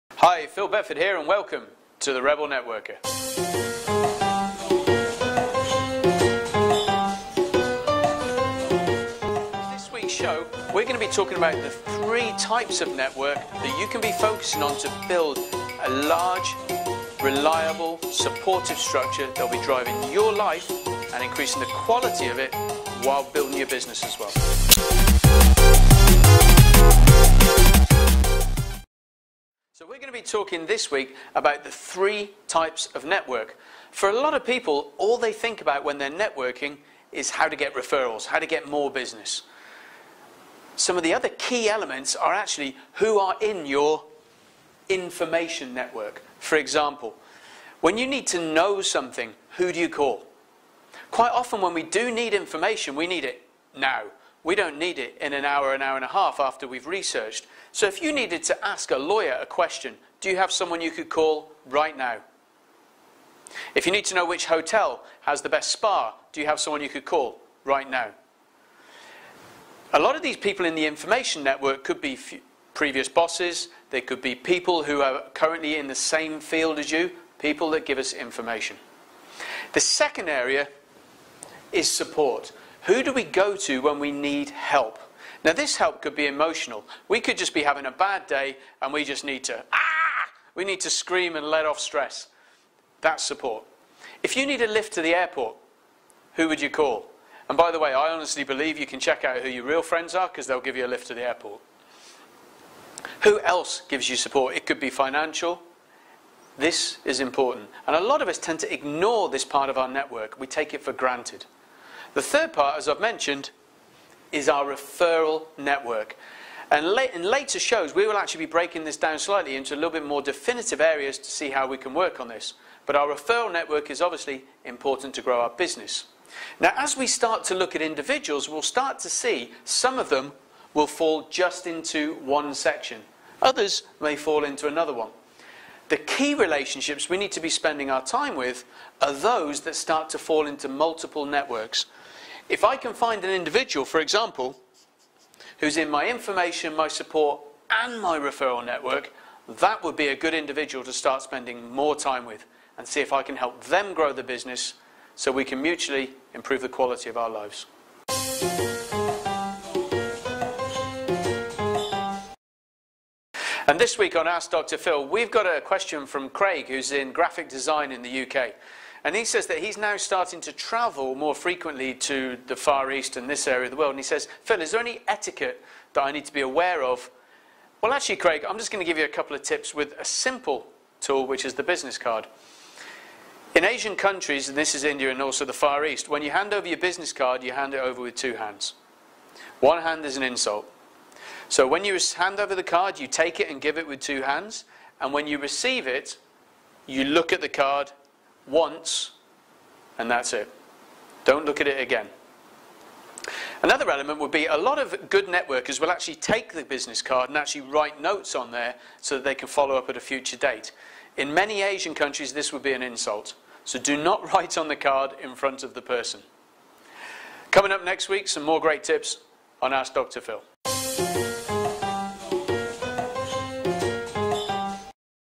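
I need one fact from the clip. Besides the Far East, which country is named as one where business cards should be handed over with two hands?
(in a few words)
India.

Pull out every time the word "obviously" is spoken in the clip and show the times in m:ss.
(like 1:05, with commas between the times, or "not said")
2:04.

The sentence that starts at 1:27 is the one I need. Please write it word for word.
We could just be having a bad day and we just need to, ah!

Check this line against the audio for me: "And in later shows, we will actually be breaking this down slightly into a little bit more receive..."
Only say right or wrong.
wrong.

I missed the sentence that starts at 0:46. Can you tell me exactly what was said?
For example, when you need to know something, who do you call?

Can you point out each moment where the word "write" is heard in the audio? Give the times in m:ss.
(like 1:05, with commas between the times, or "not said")
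3:27, 3:34.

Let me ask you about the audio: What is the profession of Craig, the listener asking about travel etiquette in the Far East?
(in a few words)
Graphic design.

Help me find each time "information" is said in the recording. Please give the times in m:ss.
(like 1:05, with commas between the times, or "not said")
0:44, 0:52, 1:10, 1:18, 2:26.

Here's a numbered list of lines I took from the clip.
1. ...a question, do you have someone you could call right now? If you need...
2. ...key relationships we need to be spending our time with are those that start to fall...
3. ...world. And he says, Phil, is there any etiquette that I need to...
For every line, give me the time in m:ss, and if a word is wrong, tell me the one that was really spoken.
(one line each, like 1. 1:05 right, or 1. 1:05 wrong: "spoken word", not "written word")
1. 0:59 right
2. 2:15 right
3. 2:53 right.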